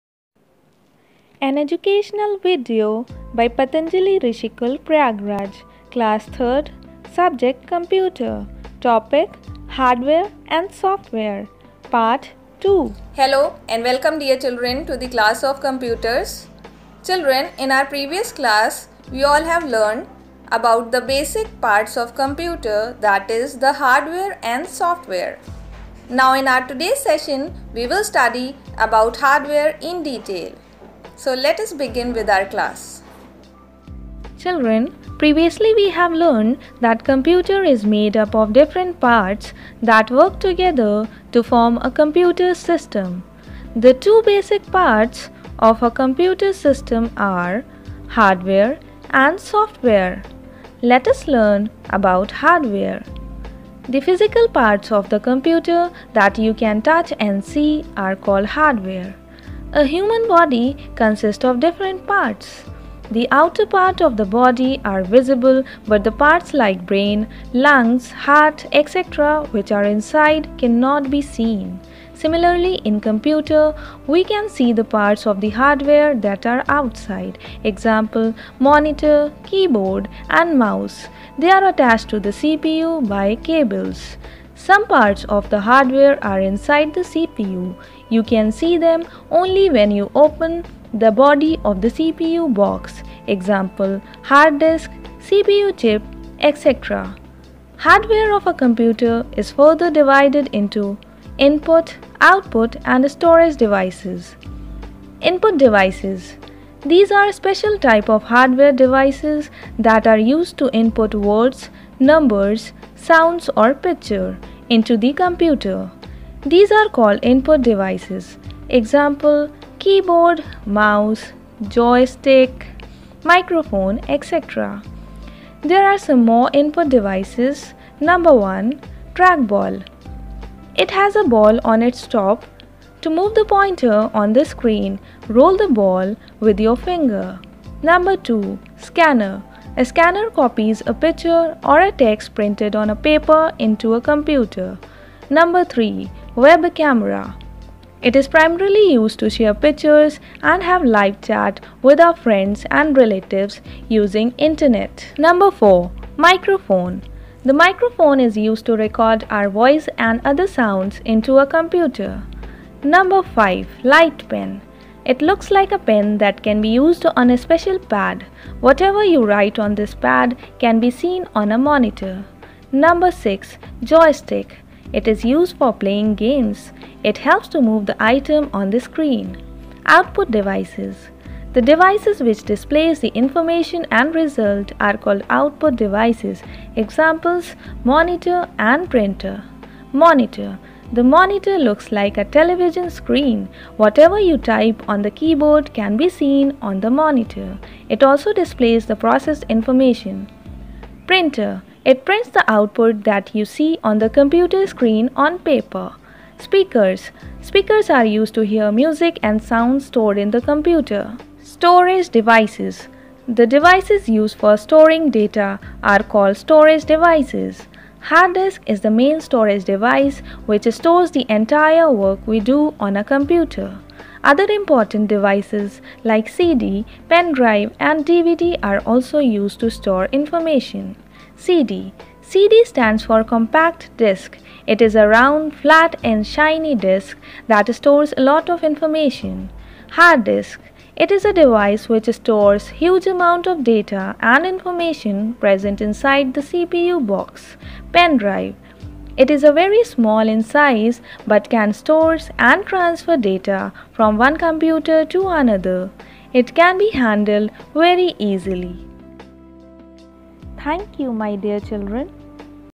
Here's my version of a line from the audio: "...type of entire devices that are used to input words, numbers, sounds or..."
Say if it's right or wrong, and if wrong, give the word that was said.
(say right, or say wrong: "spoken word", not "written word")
wrong: "hardware", not "entire".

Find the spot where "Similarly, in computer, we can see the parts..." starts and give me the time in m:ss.
1:12.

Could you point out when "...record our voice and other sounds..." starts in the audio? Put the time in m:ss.
2:38.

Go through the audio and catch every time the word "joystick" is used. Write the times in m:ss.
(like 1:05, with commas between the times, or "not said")
2:01, 2:53.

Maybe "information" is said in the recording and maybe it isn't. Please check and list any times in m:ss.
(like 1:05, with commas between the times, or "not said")
3:03, 3:19, 3:50, 3:58, 4:04.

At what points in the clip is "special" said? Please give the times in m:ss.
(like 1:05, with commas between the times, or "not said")
1:47, 2:47.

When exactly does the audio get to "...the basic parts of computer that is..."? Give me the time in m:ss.
0:20.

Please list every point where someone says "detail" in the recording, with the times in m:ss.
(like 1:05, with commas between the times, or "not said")
0:30.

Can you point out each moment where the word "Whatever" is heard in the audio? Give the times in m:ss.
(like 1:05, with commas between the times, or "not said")
2:48, 3:13.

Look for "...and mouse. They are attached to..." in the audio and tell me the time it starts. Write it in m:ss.
1:20.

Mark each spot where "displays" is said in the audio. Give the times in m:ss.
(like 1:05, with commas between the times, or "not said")
3:02, 3:18.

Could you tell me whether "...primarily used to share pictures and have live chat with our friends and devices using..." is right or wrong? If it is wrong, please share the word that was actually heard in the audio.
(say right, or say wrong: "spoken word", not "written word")
wrong: "relatives", not "devices".